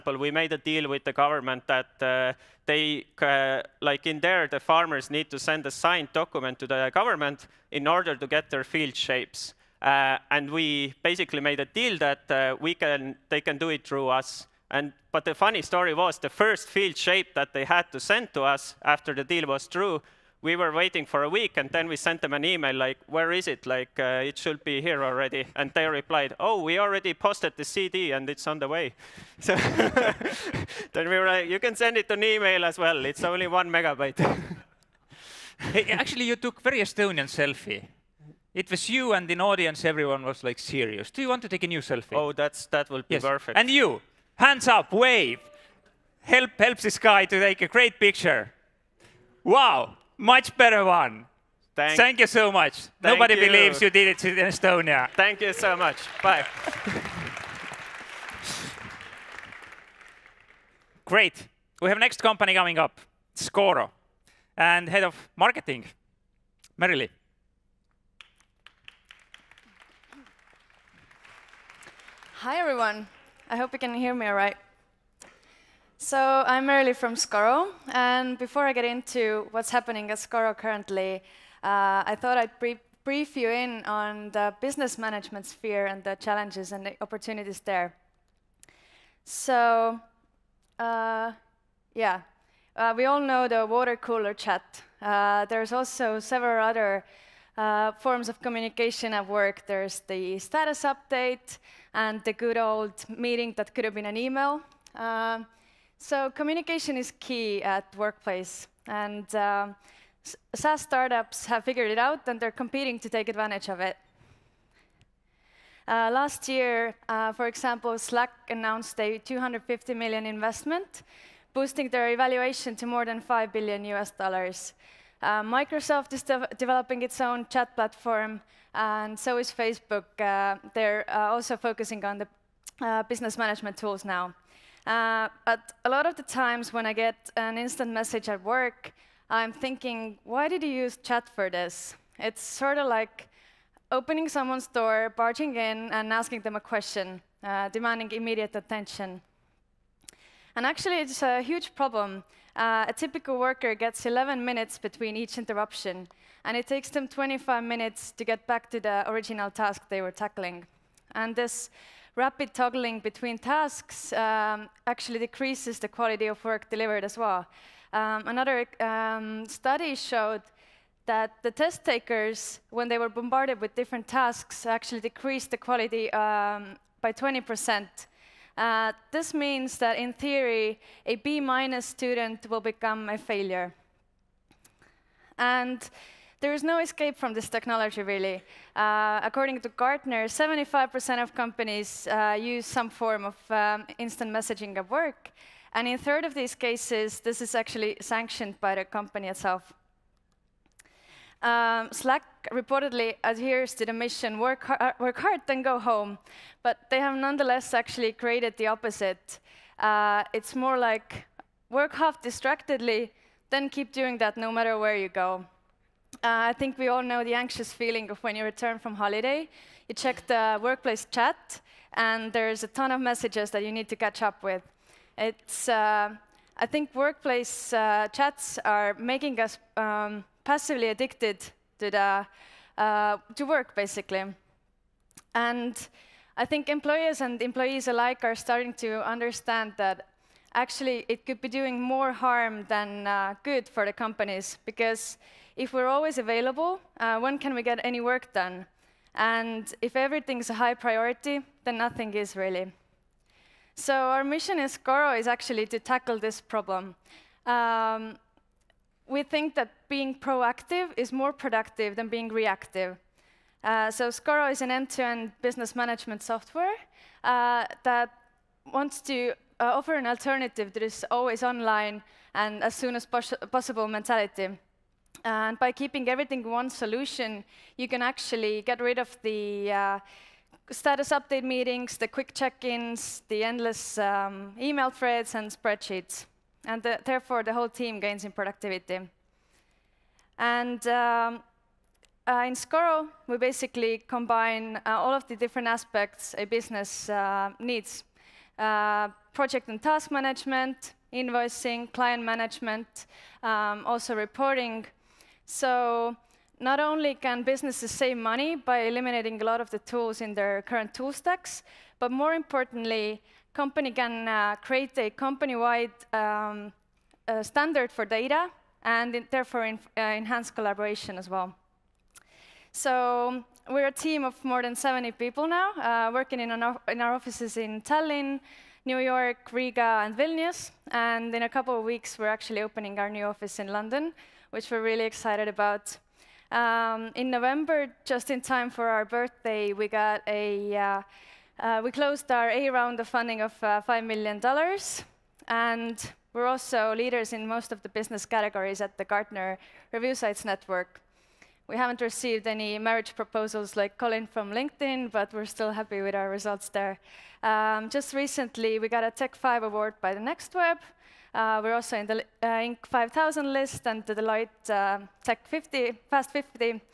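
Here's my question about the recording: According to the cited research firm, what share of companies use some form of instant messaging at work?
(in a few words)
75%.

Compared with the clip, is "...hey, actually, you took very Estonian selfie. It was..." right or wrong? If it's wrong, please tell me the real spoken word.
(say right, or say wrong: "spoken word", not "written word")
right.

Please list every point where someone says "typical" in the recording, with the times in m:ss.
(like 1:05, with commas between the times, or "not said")
2:32.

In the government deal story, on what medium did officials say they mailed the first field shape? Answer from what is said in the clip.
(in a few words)
CD.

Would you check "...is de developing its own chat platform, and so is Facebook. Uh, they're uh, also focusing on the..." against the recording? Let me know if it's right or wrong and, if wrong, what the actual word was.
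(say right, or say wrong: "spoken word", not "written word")
right.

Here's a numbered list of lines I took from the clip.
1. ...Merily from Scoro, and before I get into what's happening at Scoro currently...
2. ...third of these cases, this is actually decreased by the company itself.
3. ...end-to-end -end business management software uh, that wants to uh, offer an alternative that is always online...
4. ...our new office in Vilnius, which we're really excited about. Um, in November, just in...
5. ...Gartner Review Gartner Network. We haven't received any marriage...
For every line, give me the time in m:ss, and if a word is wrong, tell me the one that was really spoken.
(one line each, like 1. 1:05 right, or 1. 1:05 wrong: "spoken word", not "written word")
1. 1:16 right
2. 3:15 wrong: "sanctioned", not "decreased"
3. 4:24 right
4. 5:33 wrong: "London", not "Vilnius"
5. 5:49 wrong: "Sites", not "Gartner".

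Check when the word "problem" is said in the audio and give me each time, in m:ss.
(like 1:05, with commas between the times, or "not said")
2:31, 4:16.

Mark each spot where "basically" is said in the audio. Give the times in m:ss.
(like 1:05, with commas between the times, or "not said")
0:11, 3:53, 4:53.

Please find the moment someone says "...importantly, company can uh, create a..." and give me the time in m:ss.
5:12.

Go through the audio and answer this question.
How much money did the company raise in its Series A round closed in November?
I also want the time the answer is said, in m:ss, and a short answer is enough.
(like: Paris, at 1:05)
$5 million, at 5:43.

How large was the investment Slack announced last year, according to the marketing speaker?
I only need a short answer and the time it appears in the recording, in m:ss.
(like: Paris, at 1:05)
250 million, at 1:59.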